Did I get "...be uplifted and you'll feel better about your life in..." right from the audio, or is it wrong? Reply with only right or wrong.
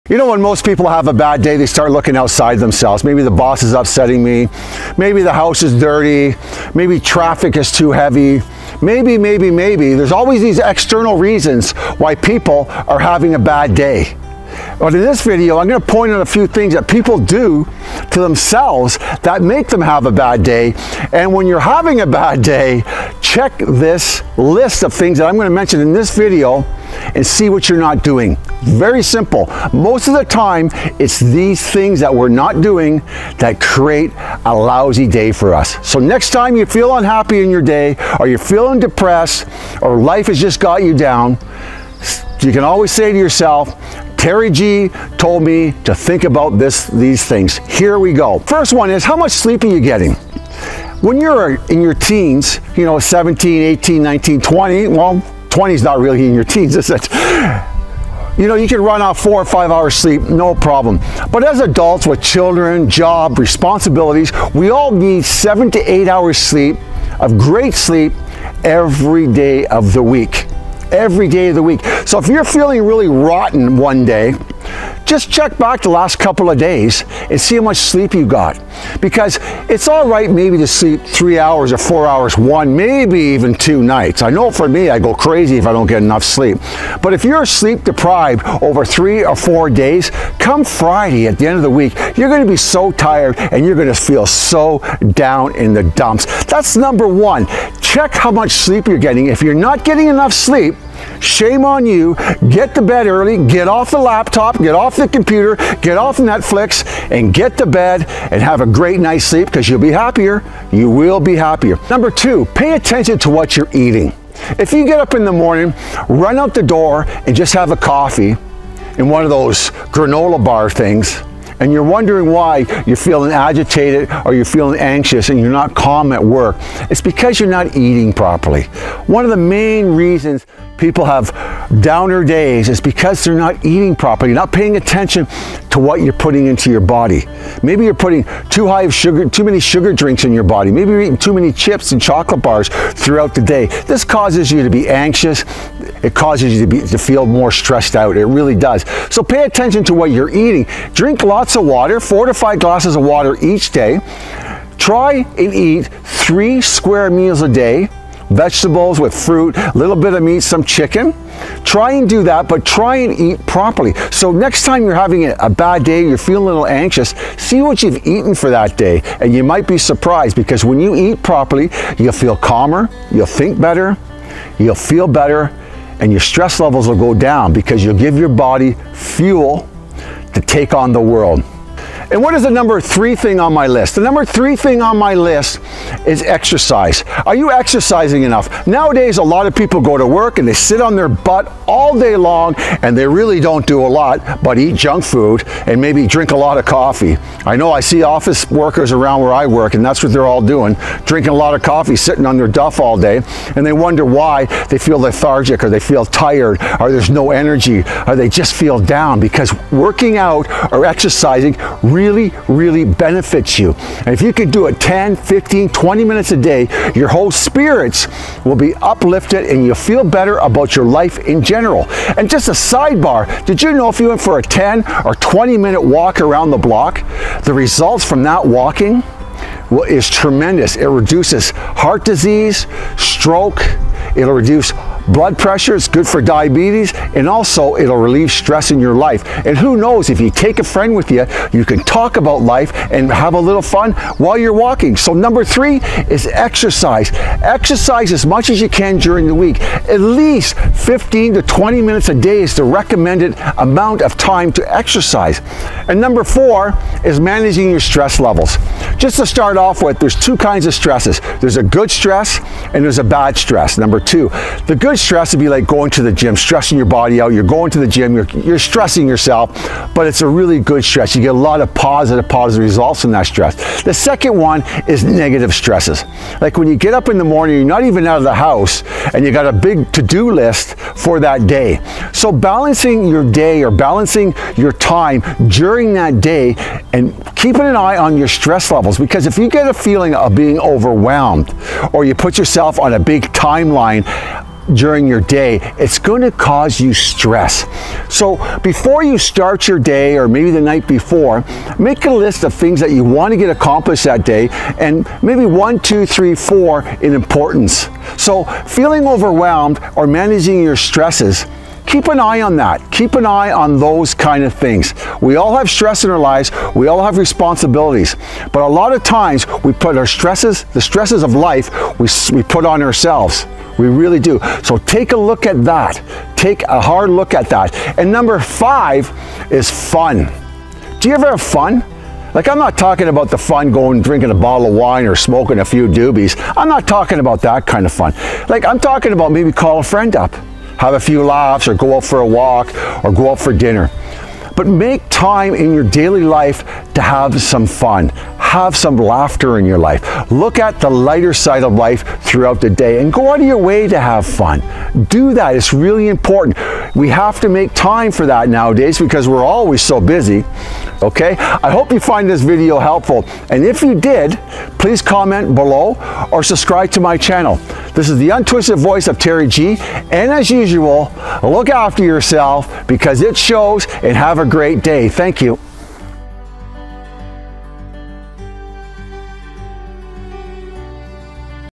right.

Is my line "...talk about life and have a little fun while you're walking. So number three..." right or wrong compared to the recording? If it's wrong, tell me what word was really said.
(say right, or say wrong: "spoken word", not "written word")
right.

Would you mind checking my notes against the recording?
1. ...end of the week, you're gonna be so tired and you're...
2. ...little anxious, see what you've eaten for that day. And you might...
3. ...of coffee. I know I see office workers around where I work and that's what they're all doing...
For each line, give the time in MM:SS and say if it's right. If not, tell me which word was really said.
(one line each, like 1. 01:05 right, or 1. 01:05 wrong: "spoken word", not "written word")
1. 01:31 right
2. 02:46 right
3. 03:16 right.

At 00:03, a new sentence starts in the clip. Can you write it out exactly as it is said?
Maybe the boss is upsetting me.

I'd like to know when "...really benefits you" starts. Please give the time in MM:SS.
03:32.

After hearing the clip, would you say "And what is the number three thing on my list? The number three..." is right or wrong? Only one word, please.
right.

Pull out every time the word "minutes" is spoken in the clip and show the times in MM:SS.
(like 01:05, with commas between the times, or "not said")
03:36, 03:45, 04:11.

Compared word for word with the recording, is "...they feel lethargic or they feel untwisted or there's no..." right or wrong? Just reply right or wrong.
wrong.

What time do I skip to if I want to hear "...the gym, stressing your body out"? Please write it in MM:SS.
04:26.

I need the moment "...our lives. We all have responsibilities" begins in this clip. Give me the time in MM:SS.
05:16.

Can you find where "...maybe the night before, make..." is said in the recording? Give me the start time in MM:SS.
05:00.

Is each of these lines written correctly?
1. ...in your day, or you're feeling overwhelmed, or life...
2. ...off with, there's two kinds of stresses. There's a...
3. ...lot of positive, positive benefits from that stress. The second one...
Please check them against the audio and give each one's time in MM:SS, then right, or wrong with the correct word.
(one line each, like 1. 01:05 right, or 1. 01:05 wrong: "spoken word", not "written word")
1. 00:37 wrong: "depressed", not "overwhelmed"
2. 04:19 right
3. 04:31 wrong: "results", not "benefits".